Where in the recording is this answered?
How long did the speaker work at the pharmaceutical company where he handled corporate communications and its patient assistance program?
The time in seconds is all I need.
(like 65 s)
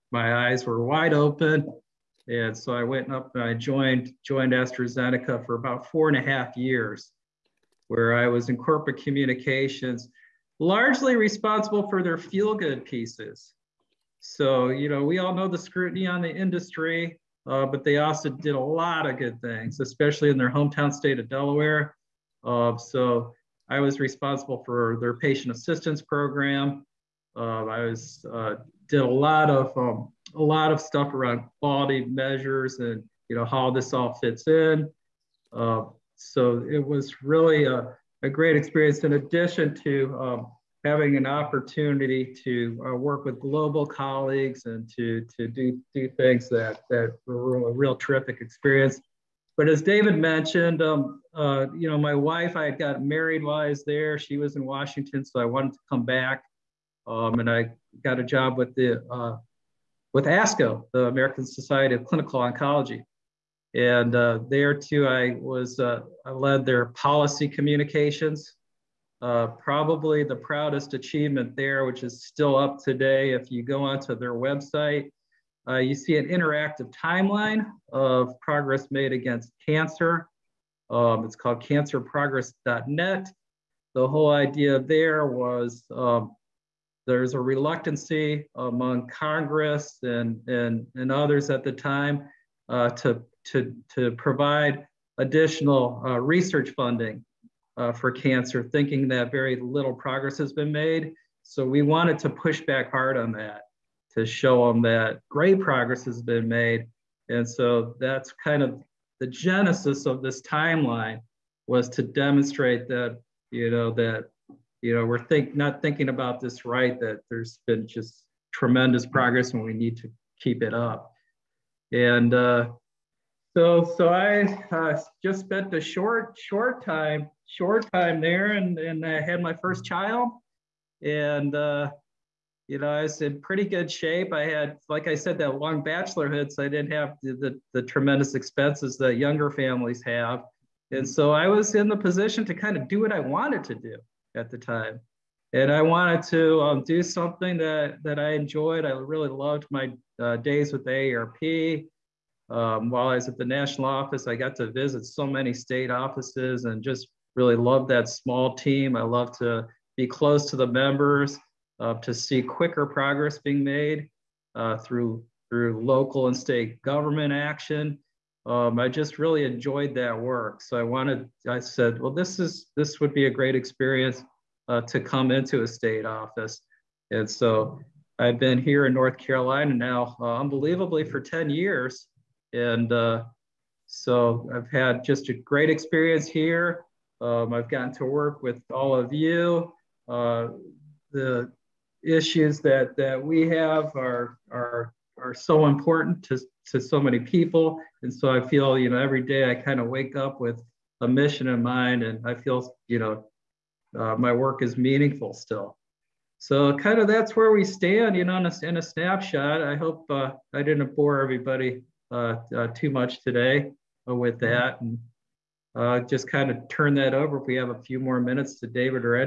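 5 s.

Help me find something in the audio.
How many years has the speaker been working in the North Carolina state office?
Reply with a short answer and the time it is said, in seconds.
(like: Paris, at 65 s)
10, at 181 s.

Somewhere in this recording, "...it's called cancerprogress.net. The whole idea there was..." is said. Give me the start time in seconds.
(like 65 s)
81 s.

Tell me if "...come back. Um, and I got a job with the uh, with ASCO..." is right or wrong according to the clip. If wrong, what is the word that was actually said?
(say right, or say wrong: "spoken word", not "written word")
right.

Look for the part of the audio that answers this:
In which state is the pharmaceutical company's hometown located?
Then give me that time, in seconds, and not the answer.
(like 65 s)
21 s.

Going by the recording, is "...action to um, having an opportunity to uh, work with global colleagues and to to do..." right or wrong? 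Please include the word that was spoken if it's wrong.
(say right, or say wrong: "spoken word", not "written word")
wrong: "addition", not "action".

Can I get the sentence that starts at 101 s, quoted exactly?
So we wanted to push back hard on that to show them that great progress has been made.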